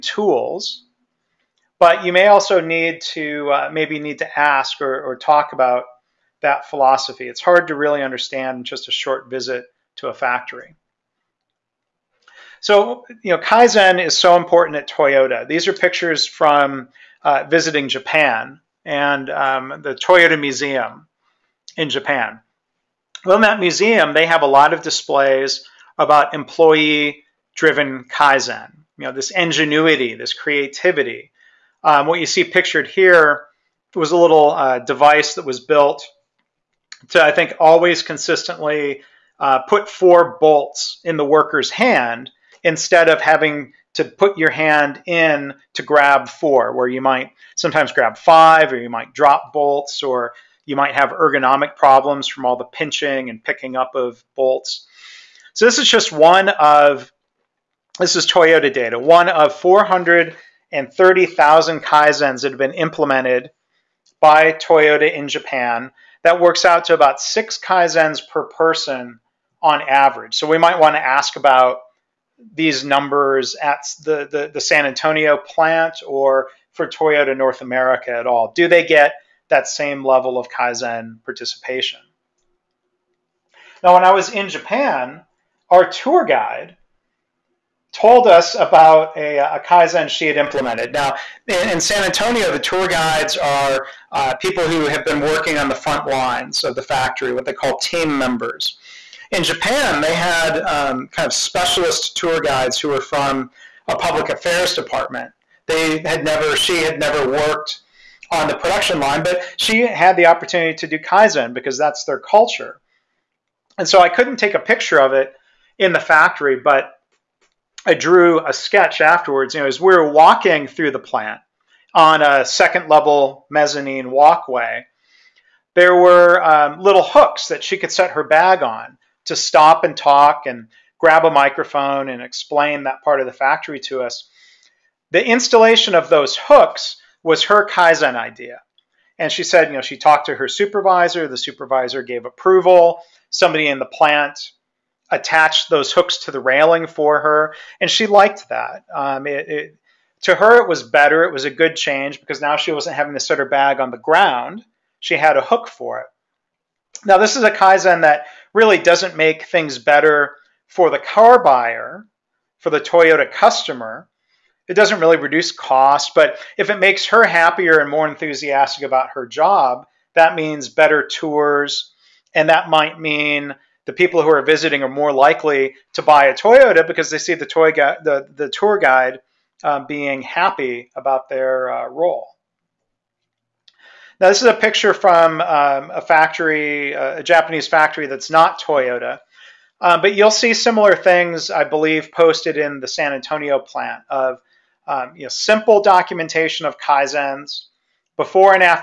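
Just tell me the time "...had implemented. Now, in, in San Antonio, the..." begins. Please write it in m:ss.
1:30.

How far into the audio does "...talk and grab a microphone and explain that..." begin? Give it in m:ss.
2:09.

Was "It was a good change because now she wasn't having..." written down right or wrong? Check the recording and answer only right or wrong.
right.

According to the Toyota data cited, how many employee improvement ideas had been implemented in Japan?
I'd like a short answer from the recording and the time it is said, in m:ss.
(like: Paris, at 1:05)
430,000, at 0:59.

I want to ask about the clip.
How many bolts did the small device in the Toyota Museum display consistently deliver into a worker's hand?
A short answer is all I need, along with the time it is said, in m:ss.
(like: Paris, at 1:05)
4, at 0:39.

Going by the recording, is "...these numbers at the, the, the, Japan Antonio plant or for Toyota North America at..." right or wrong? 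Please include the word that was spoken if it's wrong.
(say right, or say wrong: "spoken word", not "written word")
wrong: "San", not "Japan".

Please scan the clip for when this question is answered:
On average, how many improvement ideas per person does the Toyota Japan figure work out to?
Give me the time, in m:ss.
1:07.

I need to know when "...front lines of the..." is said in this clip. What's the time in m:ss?
1:35.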